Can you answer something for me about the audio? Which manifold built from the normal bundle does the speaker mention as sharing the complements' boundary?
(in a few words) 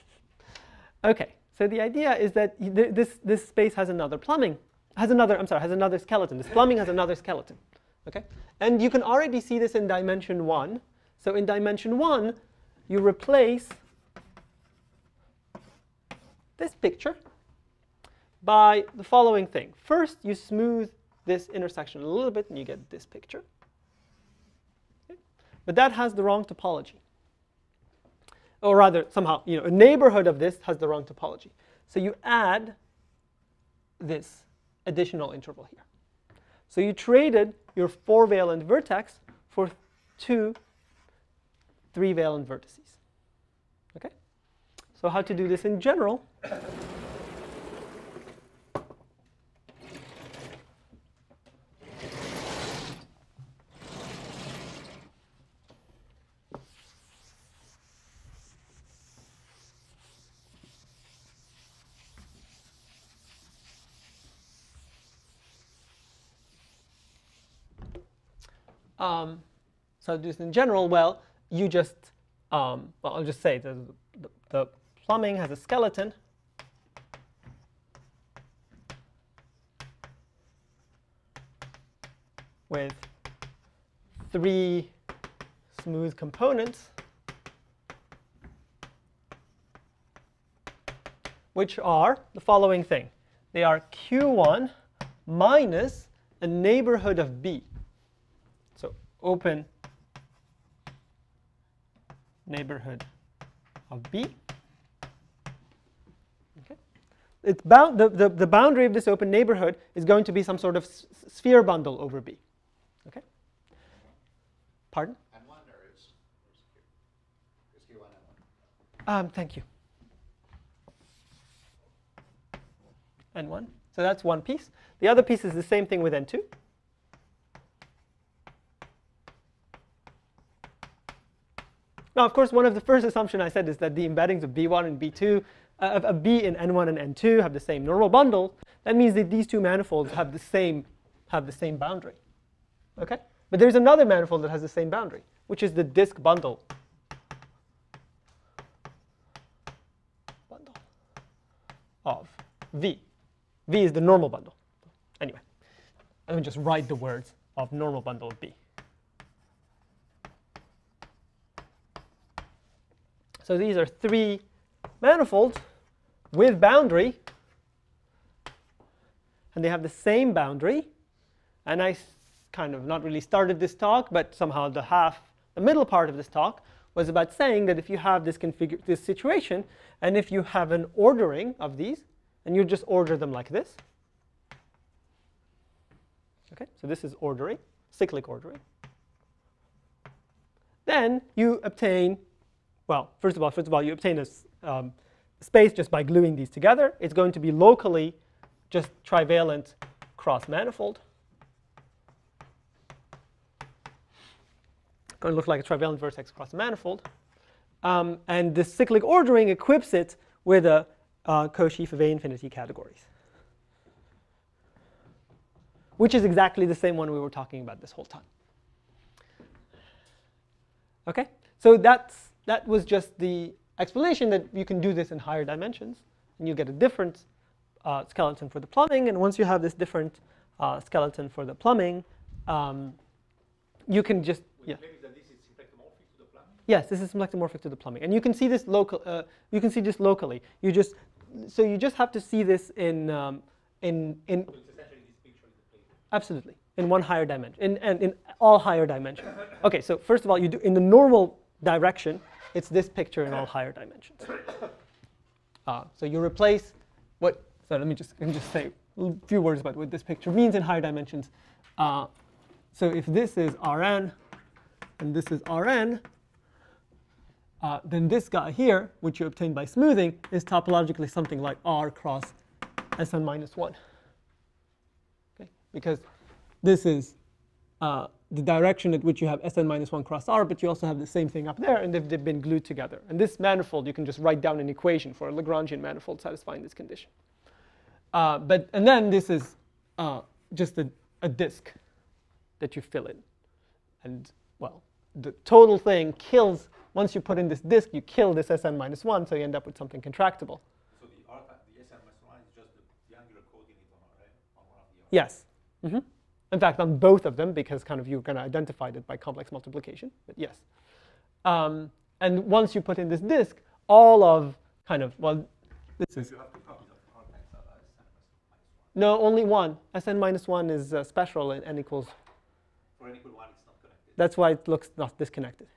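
disk bundle.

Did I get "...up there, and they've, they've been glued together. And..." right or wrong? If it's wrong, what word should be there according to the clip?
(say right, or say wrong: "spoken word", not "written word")
right.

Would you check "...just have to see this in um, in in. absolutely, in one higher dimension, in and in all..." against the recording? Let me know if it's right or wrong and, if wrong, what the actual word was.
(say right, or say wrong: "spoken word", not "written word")
right.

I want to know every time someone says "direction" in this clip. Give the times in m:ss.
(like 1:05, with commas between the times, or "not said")
4:11, 4:38.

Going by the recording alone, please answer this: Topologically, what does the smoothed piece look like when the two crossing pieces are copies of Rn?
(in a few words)
R cross Sn minus 1.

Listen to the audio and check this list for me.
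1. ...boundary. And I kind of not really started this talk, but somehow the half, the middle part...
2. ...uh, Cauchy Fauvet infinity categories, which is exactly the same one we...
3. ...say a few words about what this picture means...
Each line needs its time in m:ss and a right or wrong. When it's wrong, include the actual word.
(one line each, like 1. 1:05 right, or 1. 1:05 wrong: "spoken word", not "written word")
1. 2:50 right
2. 3:31 right
3. 4:18 right.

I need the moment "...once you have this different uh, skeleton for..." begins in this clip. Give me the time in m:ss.
3:49.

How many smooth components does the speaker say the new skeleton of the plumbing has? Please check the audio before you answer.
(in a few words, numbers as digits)
3.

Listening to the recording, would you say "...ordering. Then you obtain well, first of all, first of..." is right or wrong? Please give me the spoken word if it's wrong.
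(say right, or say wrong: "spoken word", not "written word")
right.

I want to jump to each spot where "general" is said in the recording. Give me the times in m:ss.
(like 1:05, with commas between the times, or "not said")
0:45, 1:10.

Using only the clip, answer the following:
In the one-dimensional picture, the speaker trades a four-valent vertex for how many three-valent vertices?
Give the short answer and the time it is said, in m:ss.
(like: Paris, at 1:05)
2, at 0:40.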